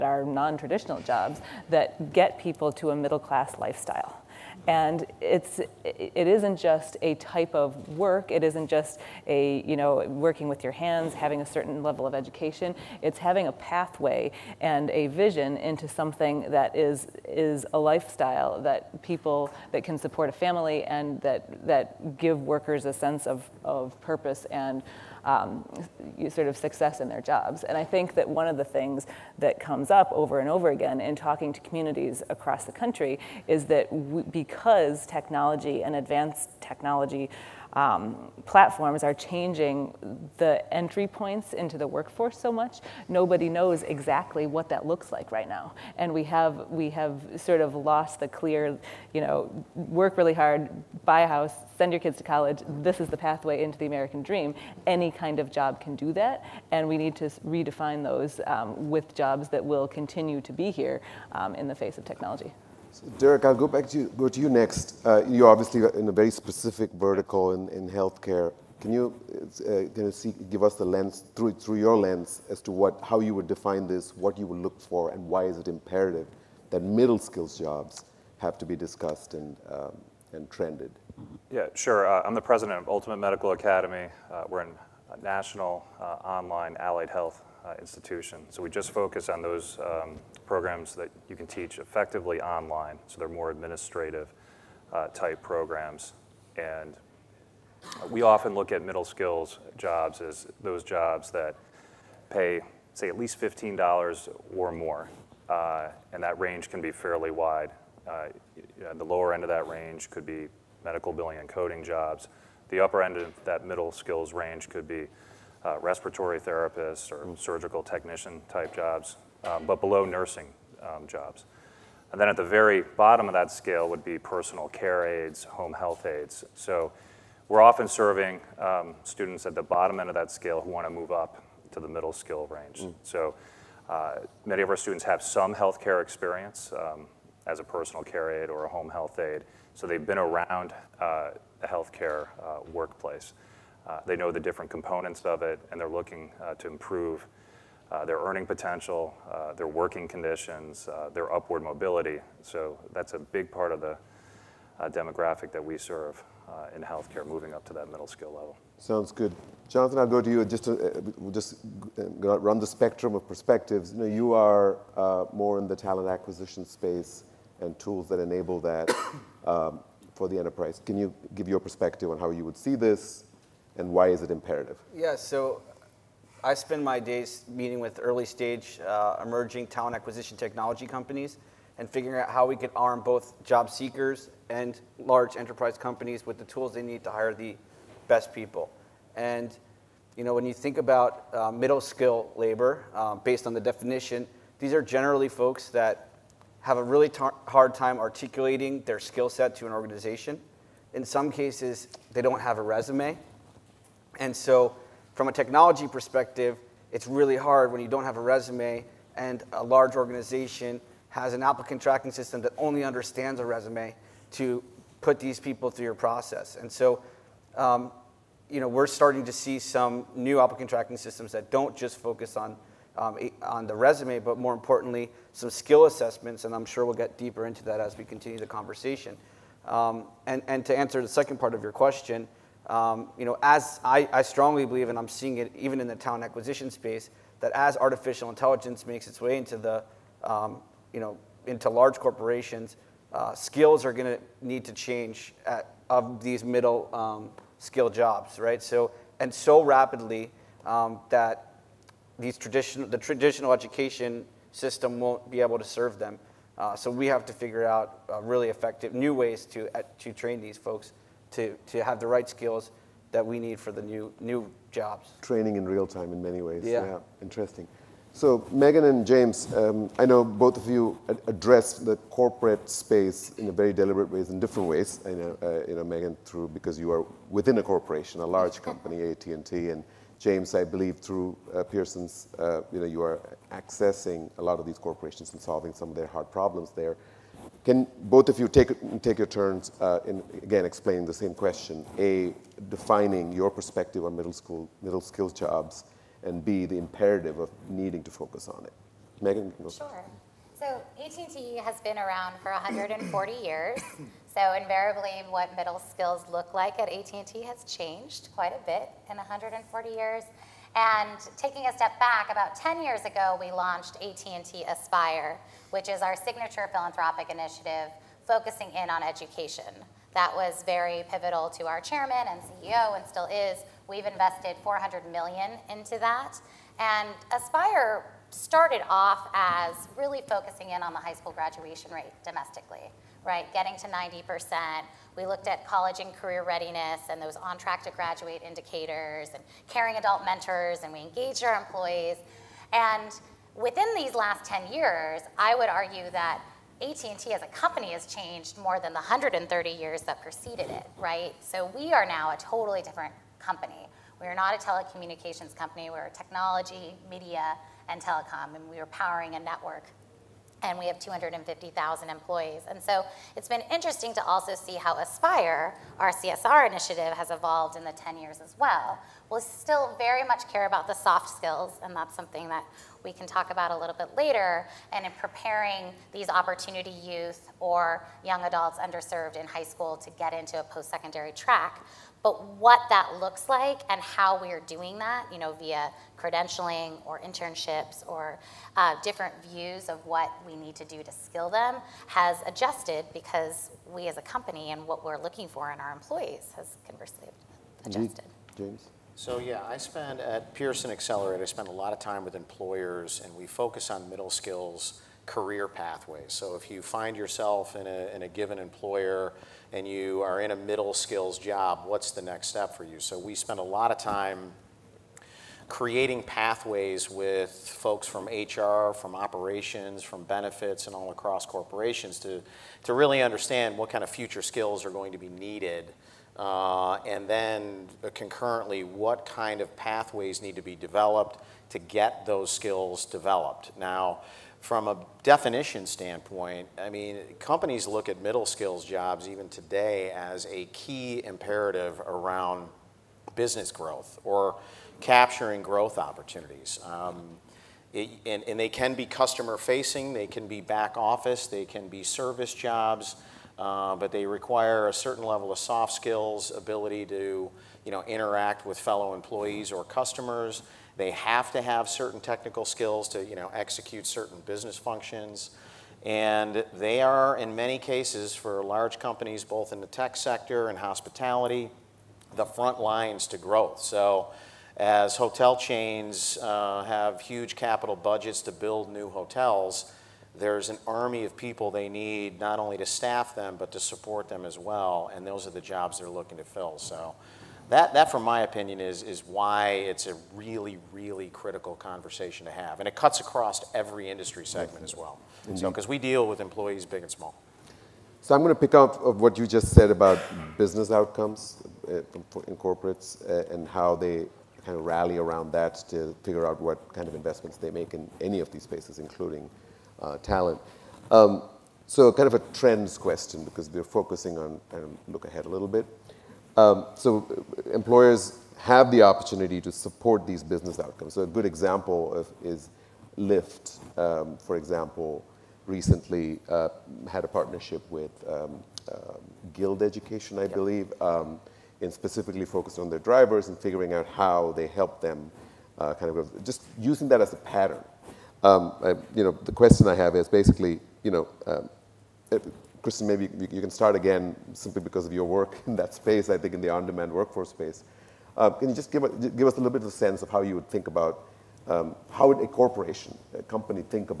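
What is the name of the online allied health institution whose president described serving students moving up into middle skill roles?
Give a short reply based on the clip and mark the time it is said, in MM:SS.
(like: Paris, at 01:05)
Ultimate Medical Academy, at 01:22.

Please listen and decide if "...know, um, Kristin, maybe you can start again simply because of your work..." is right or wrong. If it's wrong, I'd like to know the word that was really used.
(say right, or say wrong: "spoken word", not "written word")
right.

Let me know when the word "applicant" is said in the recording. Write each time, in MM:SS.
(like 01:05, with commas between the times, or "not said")
03:31, 03:40.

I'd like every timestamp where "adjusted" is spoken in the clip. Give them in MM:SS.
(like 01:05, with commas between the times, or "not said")
06:32, 06:37.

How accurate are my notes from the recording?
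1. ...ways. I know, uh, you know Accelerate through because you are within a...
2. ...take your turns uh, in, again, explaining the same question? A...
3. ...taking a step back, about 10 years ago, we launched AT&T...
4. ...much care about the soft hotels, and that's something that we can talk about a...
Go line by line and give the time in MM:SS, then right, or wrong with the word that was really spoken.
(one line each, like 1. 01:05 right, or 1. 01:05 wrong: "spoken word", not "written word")
1. 04:34 wrong: "Meghan", not "Accelerate"
2. 04:49 right
3. 05:11 right
4. 06:10 wrong: "skills", not "hotels".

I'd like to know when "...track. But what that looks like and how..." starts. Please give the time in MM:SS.
06:21.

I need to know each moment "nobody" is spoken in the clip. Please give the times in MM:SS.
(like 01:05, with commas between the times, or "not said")
00:43.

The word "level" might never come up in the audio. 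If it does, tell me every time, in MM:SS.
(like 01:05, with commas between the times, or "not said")
00:11, 02:38, 07:35.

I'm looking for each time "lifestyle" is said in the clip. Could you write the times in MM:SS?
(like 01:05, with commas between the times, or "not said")
00:03, 00:17.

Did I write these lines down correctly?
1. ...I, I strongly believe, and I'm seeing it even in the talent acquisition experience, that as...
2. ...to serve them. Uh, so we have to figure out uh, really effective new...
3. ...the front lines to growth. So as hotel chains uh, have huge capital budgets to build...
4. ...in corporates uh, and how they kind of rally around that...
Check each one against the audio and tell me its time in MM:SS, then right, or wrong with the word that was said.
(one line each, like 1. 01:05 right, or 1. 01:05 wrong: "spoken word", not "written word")
1. 03:53 wrong: "space", not "experience"
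2. 04:15 right
3. 07:52 right
4. 08:22 right.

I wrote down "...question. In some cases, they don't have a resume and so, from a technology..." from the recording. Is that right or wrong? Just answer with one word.
wrong.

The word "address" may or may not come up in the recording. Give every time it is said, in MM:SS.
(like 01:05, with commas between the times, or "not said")
04:31.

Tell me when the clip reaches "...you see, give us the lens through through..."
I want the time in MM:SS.
01:10.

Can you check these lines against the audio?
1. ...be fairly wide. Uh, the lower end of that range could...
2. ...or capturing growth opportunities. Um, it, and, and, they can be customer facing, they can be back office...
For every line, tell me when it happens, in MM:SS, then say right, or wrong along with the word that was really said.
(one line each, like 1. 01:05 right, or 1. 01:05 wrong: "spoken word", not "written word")
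1. 01:46 right
2. 07:24 right.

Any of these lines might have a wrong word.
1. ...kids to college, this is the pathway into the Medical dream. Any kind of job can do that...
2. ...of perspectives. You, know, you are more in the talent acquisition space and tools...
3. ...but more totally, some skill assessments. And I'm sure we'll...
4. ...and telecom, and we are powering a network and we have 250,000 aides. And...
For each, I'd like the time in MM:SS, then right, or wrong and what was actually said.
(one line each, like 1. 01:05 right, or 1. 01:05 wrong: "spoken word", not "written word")
1. 00:51 wrong: "American", not "Medical"
2. 02:43 right
3. 03:44 wrong: "importantly", not "totally"
4. 05:57 wrong: "employees", not "aides".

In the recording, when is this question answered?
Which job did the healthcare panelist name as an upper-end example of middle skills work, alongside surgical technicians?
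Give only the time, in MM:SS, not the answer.
01:55.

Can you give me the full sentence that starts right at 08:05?
And those are the jobs they're looking to fill.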